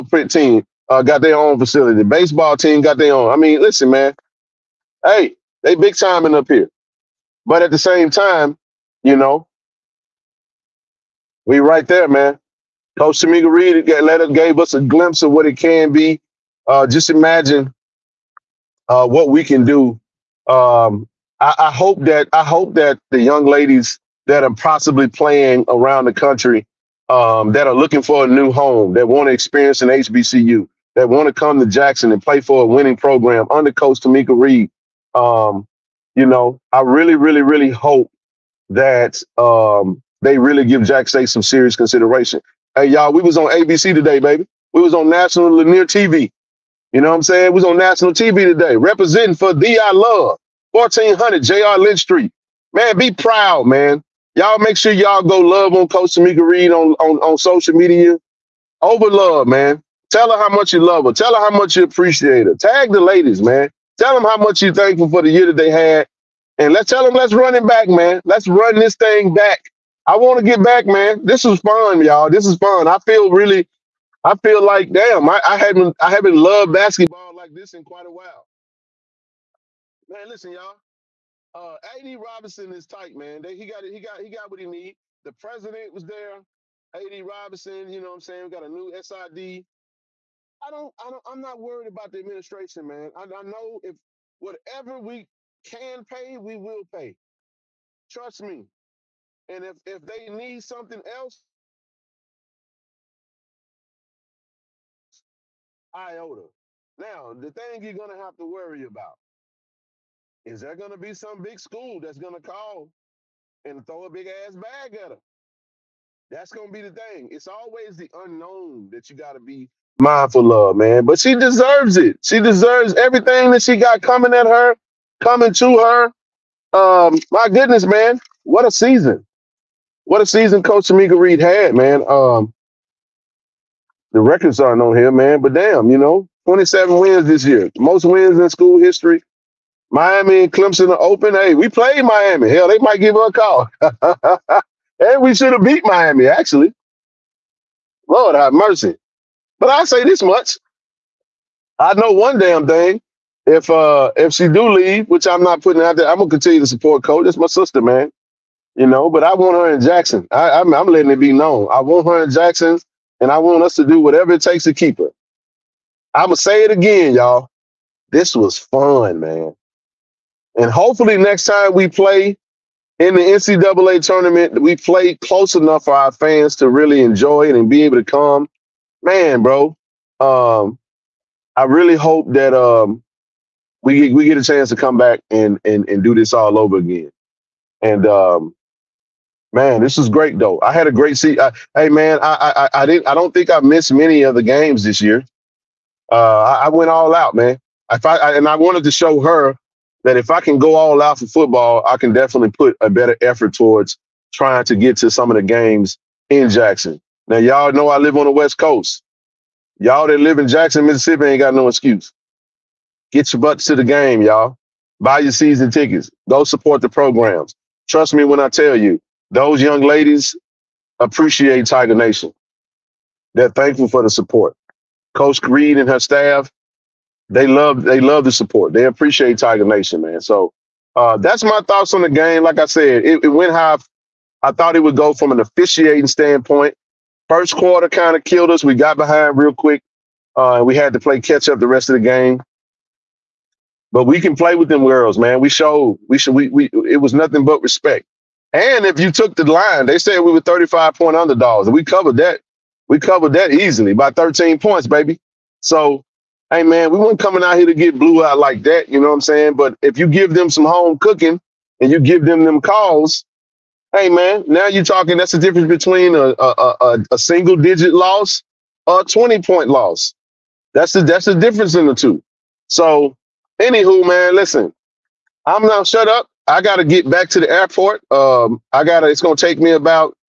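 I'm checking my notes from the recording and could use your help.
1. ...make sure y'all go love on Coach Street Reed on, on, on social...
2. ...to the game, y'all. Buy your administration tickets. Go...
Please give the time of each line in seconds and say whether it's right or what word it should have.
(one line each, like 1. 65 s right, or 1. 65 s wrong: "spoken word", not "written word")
1. 54 s wrong: "Tomekia", not "Street"
2. 213 s wrong: "season", not "administration".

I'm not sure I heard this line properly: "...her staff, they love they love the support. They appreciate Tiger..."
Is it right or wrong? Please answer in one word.
right.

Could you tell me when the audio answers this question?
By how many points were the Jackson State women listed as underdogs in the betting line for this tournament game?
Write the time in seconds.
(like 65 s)
250 s.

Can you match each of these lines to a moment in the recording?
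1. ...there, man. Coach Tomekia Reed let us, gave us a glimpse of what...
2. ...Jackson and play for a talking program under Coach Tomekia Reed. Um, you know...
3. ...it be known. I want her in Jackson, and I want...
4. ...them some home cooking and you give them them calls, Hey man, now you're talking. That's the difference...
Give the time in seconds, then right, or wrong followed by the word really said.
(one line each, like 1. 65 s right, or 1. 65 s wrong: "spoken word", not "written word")
1. 11 s right
2. 31 s wrong: "winning", not "talking"
3. 161 s right
4. 260 s right.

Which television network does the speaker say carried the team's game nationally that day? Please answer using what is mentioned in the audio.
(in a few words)
ABC.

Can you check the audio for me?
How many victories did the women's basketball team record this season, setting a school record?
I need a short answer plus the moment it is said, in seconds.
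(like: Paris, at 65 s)
27, at 136 s.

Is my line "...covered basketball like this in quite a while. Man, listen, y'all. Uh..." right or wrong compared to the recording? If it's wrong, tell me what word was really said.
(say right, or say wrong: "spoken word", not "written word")
wrong: "loved", not "covered".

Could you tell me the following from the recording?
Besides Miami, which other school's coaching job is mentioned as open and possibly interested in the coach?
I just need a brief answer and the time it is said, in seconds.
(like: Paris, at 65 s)
Clemson, at 140 s.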